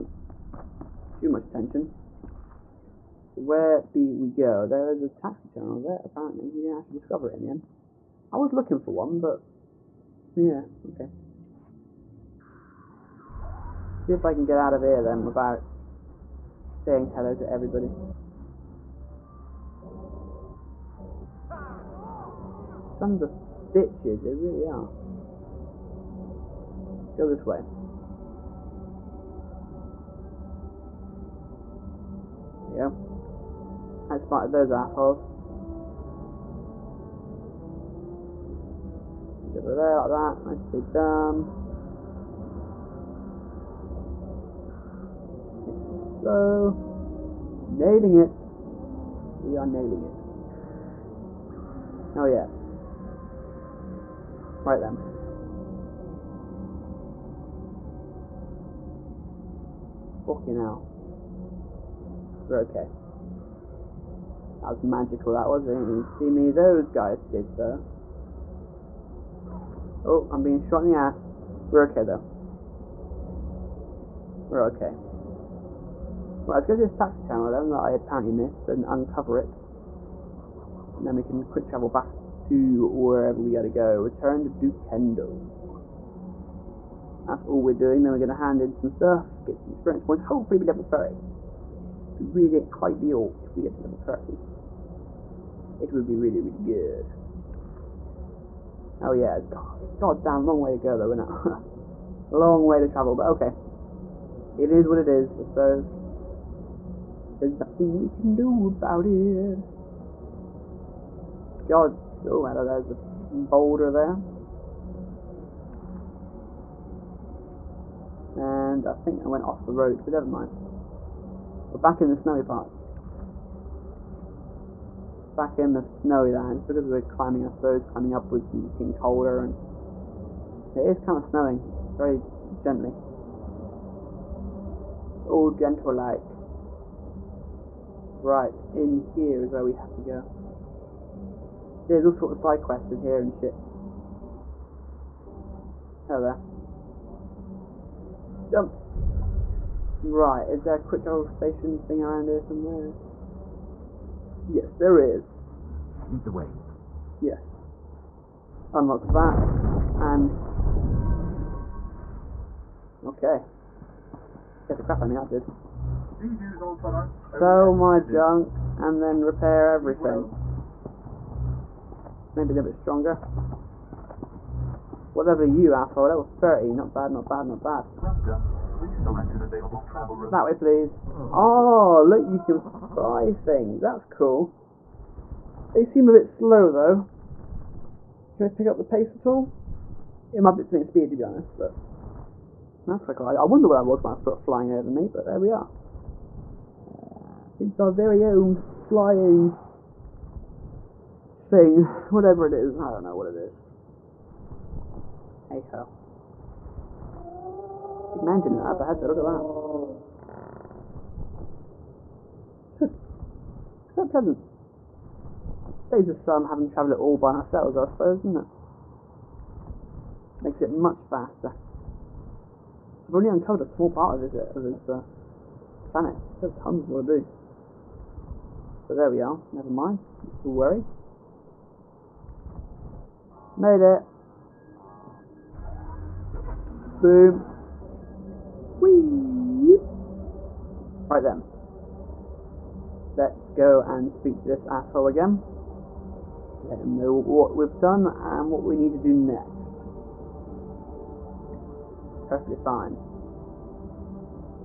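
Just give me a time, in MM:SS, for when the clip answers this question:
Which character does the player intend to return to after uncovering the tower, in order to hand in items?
01:24.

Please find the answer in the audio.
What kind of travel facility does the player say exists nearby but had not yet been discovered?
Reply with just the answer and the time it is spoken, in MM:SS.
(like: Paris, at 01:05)
Taxi terminal, at 00:05.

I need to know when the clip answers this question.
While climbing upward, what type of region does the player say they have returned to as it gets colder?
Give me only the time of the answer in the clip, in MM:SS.
02:02.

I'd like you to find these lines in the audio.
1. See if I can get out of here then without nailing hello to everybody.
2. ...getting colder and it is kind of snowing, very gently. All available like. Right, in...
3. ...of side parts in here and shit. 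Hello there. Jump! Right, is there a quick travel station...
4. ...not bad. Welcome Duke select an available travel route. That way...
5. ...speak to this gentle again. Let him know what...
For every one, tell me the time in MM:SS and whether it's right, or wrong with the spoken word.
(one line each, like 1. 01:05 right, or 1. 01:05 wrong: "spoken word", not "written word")
1. 00:13 wrong: "saying", not "nailing"
2. 02:08 wrong: "gentle", not "available"
3. 02:22 wrong: "quests", not "parts"
4. 02:57 wrong: "Please", not "Duke"
5. 04:04 wrong: "asshole", not "gentle".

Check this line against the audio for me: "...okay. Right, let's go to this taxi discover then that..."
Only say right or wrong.
wrong.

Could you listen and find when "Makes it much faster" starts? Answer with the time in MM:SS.
03:40.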